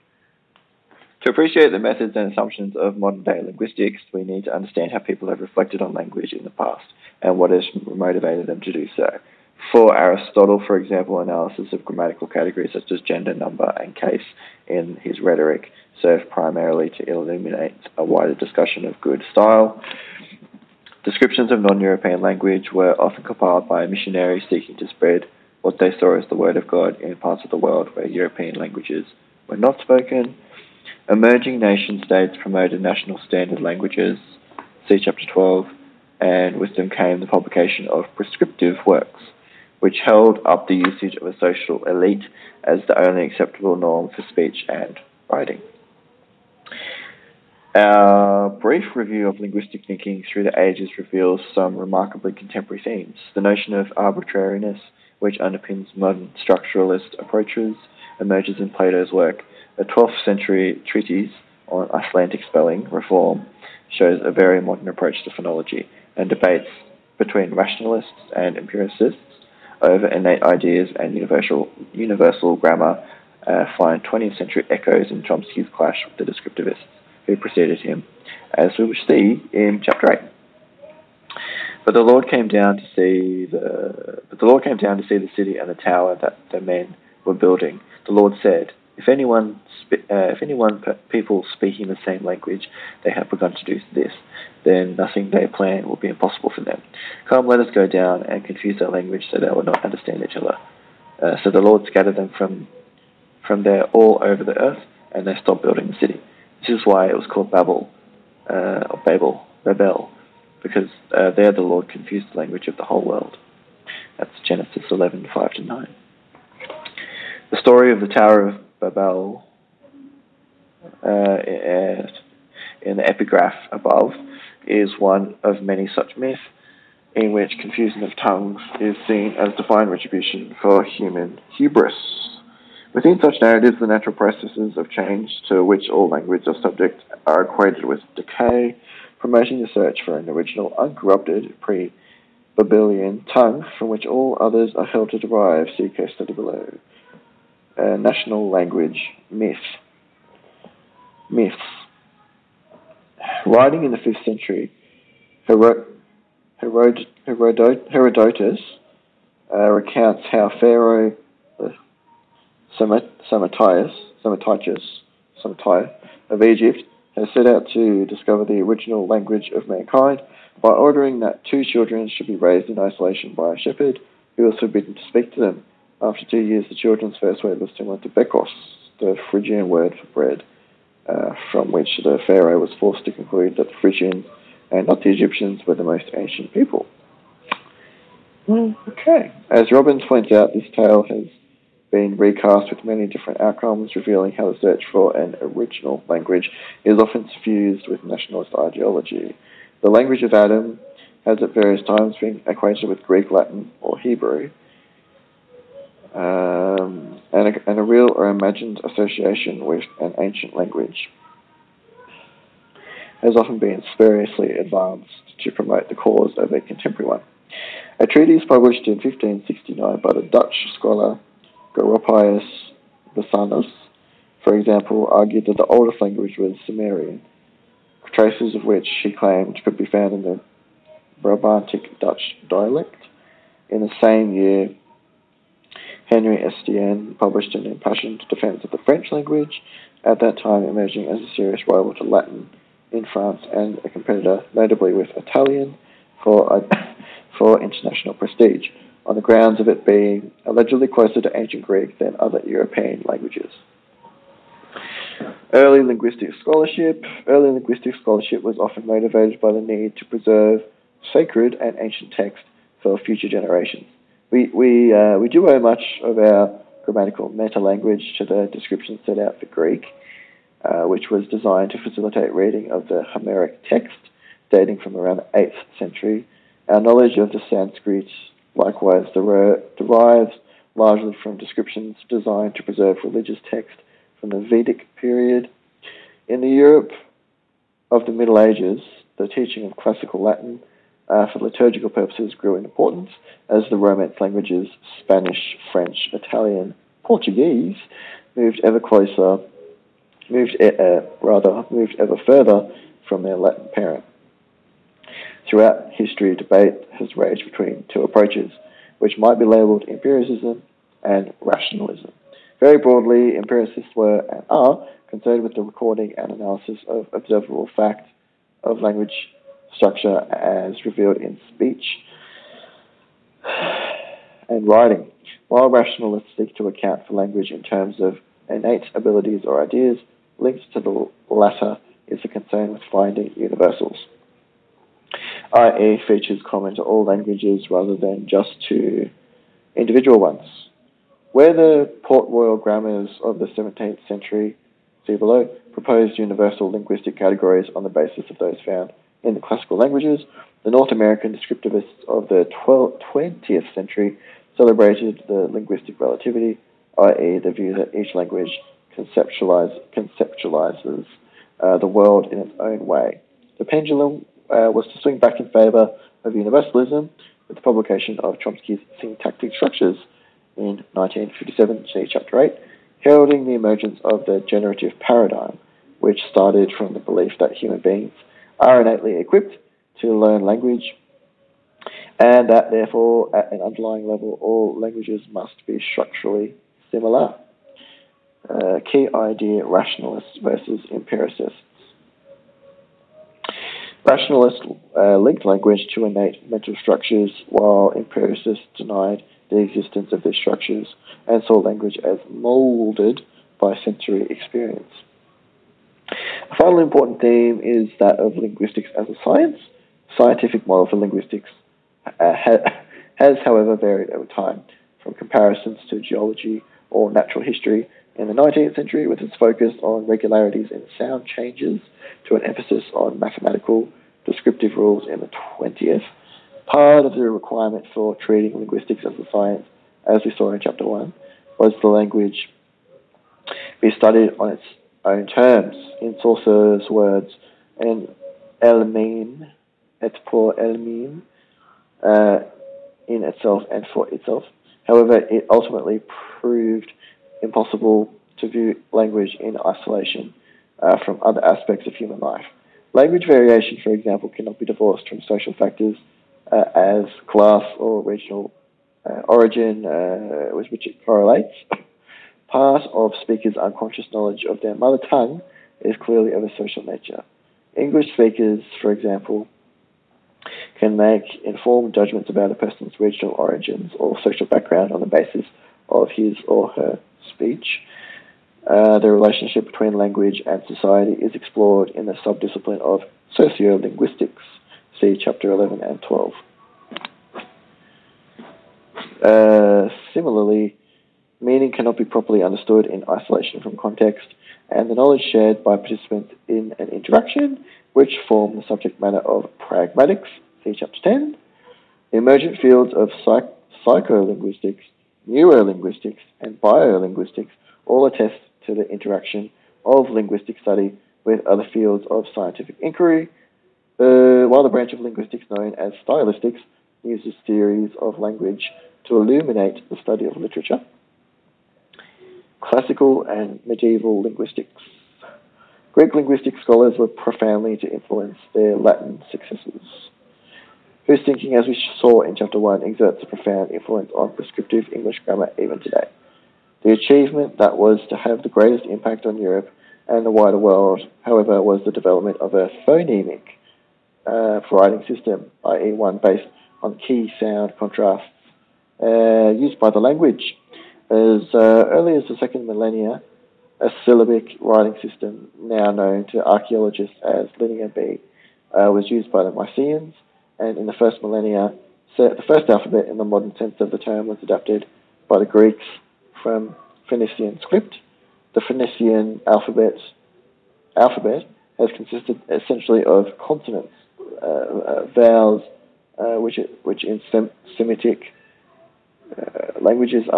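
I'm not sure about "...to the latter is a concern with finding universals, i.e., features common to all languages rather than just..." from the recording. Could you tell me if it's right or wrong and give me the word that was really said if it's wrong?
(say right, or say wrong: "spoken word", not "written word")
right.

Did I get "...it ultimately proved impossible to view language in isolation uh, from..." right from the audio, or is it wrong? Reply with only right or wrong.
right.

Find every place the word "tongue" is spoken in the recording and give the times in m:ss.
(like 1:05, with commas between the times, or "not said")
2:08, 2:23, 7:45.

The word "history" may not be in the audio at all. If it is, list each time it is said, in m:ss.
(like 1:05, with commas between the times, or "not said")
5:05, 6:57.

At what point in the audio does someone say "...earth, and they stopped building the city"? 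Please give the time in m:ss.
1:44.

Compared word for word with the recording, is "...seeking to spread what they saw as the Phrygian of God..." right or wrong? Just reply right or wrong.
wrong.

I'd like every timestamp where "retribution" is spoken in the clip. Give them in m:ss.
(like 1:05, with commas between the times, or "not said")
2:09.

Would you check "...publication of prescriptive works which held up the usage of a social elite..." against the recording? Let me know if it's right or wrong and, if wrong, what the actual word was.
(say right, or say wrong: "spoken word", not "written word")
right.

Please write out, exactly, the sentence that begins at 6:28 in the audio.
Uh, key idea rationalists versus empiricists.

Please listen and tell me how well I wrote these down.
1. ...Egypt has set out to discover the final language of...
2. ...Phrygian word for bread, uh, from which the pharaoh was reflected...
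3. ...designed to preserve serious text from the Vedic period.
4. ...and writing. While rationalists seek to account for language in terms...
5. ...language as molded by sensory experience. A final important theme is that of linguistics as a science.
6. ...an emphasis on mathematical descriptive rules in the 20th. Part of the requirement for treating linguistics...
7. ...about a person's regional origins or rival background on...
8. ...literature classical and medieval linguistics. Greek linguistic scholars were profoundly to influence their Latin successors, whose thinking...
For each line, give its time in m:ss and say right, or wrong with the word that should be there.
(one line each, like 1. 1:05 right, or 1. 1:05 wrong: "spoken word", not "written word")
1. 2:46 wrong: "original", not "final"
2. 2:59 wrong: "forced", not "reflected"
3. 4:42 wrong: "religious", not "serious"
4. 5:24 right
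5. 6:41 right
6. 7:02 right
7. 7:52 wrong: "social", not "rival"
8. 8:40 right.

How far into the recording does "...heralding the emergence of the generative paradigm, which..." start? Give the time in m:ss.
6:13.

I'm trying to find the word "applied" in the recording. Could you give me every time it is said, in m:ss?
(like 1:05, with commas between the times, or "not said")
not said.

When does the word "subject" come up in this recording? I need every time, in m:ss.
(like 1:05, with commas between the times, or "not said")
2:16, 8:18.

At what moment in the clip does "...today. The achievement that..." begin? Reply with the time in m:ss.
8:55.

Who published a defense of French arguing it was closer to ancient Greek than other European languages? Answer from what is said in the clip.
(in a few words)
Henry Estienne.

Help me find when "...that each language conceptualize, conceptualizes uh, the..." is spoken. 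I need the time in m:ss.
5:57.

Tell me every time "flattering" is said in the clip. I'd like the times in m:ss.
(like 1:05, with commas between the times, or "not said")
not said.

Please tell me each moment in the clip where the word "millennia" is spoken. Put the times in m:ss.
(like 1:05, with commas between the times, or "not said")
9:12, 9:21.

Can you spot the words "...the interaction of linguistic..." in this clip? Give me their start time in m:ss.
8:28.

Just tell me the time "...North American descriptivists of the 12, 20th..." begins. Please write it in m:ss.
5:50.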